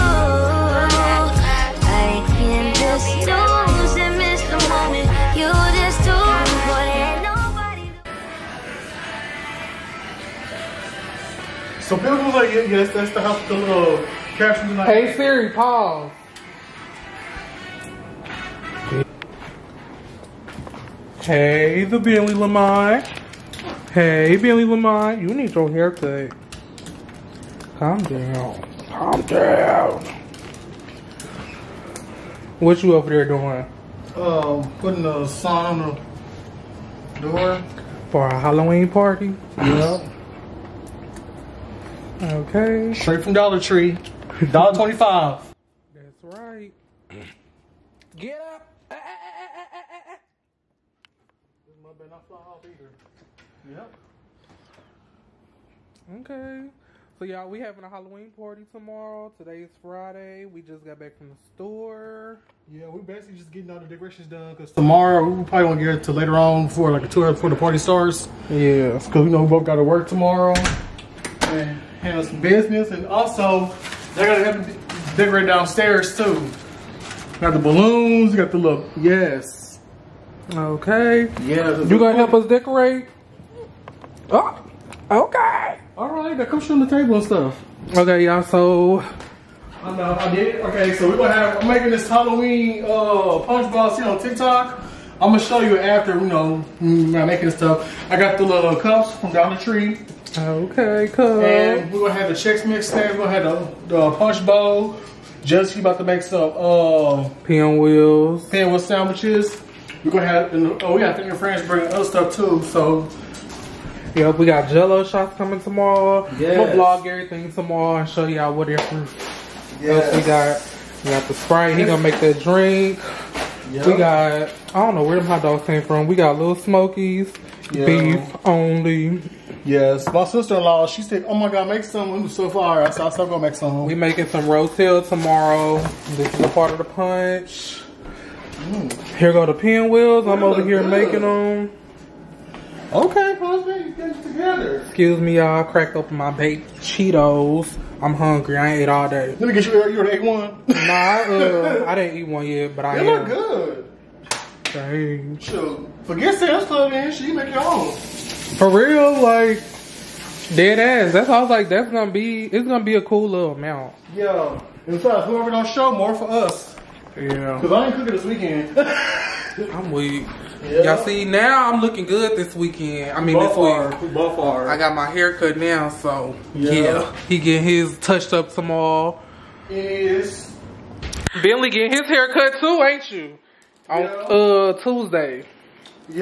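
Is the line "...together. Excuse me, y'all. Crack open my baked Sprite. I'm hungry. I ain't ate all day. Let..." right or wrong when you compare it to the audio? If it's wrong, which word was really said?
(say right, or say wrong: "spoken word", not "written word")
wrong: "Cheetos", not "Sprite".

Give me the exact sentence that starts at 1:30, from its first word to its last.
Okay, so we're gonna have, I'm making this Halloween uh, punch bowl.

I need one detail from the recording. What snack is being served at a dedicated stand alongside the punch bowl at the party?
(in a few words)
Chex mix.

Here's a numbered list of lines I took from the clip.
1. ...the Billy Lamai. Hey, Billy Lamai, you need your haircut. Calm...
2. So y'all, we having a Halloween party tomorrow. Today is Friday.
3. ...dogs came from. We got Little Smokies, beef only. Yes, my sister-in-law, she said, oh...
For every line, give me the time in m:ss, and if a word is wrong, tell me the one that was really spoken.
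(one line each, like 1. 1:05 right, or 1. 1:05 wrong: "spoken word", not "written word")
1. 0:21 right
2. 0:57 right
3. 2:05 right.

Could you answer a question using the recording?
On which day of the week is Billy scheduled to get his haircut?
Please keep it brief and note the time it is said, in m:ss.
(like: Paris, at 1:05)
Tuesday, at 3:04.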